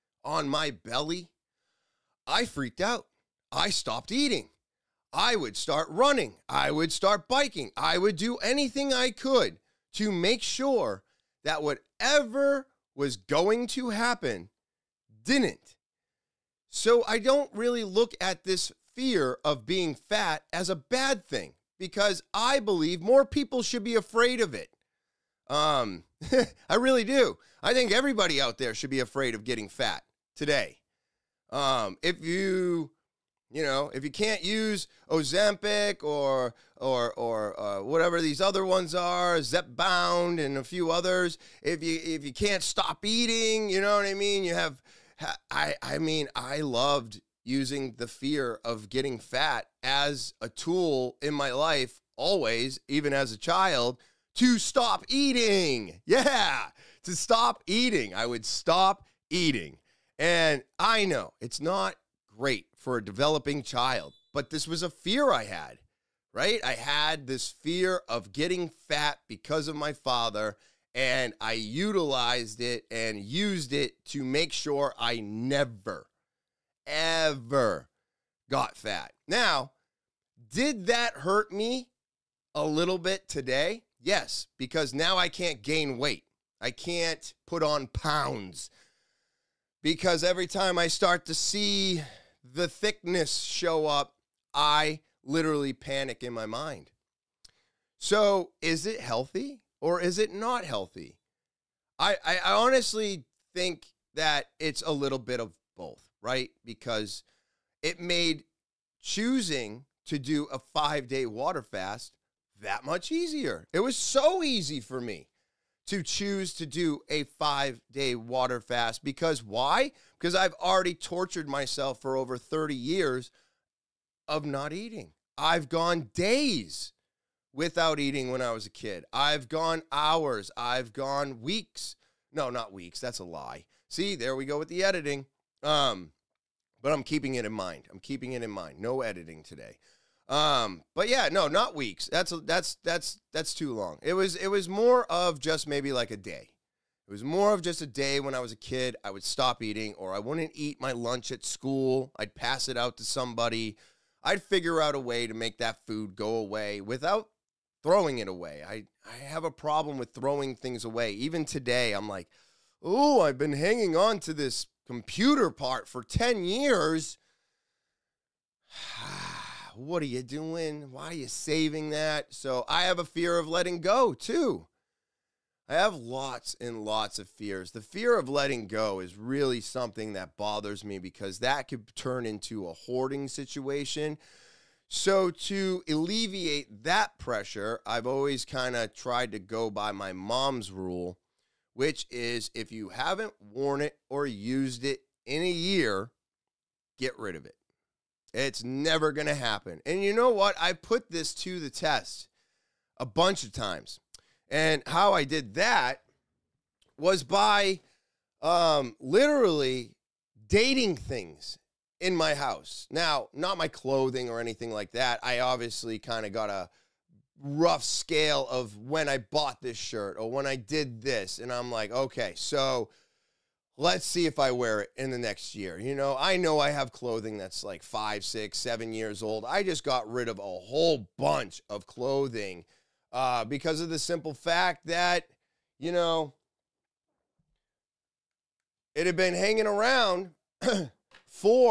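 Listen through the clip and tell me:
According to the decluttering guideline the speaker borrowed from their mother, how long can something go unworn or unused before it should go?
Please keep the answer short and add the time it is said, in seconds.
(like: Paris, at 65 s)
a year, at 195 s.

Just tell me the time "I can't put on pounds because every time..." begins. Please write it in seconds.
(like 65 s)
86 s.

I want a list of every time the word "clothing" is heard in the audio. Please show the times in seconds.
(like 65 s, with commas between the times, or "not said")
213 s, 226 s, 231 s.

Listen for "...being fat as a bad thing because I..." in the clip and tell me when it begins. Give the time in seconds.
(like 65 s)
19 s.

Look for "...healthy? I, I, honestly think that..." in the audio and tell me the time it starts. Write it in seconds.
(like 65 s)
100 s.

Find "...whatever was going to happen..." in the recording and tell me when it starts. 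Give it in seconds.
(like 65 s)
11 s.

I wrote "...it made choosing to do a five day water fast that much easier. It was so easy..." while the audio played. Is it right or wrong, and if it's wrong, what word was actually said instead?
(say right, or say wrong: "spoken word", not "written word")
right.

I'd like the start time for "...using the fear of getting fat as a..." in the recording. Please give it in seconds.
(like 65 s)
47 s.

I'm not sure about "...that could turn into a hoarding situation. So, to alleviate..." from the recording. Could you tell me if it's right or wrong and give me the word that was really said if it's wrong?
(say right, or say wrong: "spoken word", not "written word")
right.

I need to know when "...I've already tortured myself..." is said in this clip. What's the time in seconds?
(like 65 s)
120 s.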